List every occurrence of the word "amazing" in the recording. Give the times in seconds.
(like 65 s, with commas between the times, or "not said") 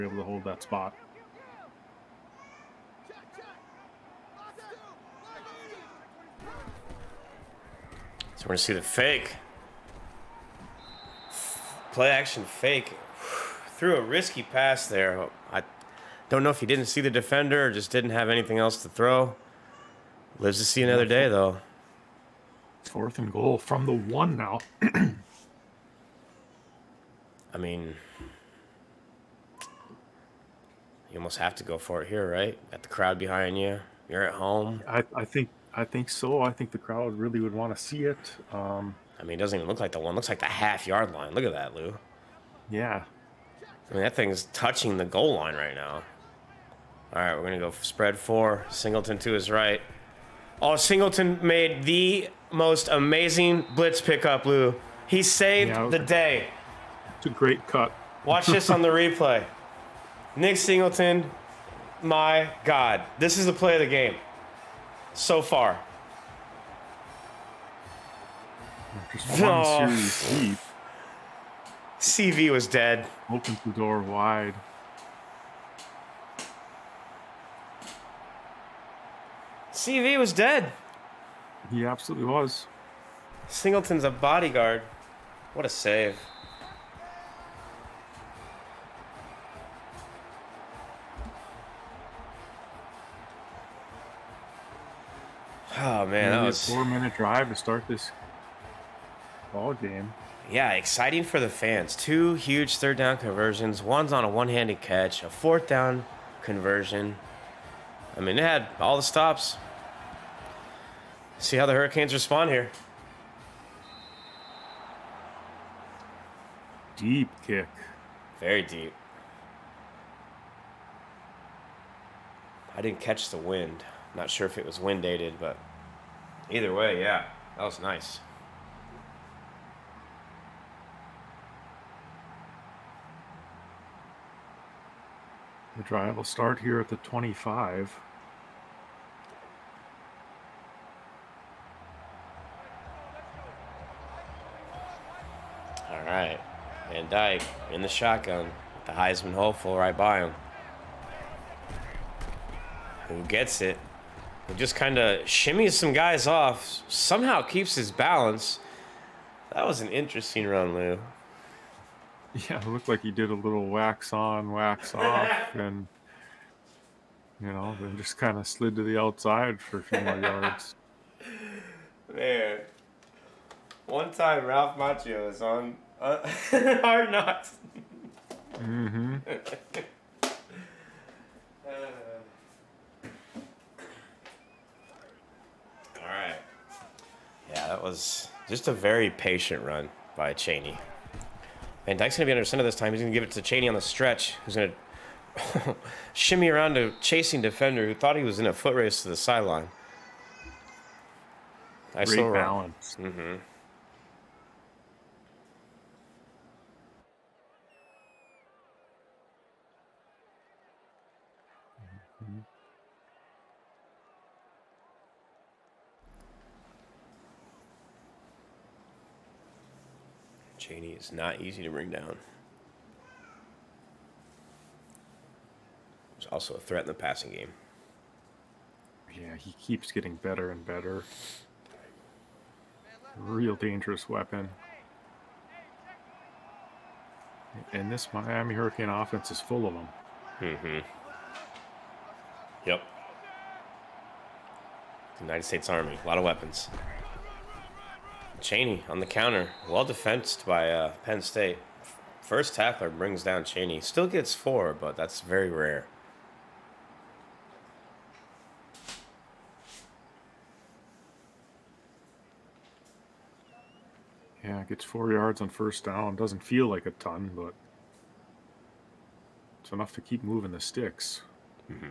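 52 s.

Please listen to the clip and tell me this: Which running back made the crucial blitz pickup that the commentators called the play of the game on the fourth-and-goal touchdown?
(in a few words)
Nick Singleton.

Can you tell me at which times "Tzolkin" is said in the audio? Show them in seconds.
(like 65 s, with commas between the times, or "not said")
not said.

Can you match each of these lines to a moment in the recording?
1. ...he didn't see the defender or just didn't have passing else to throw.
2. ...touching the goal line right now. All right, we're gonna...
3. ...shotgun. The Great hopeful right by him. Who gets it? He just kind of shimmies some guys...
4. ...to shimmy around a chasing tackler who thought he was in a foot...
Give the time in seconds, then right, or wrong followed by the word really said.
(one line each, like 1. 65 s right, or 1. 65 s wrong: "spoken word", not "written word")
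1. 16 s wrong: "anything", not "passing"
2. 44 s right
3. 147 s wrong: "Heisman", not "Great"
4. 195 s wrong: "defender", not "tackler".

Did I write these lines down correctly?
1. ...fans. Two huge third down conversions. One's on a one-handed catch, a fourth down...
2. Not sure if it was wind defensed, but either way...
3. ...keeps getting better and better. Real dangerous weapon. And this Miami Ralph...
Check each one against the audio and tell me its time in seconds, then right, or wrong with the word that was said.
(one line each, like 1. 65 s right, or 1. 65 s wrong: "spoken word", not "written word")
1. 101 s right
2. 124 s wrong: "aided", not "defensed"
3. 229 s wrong: "Hurricane", not "Ralph".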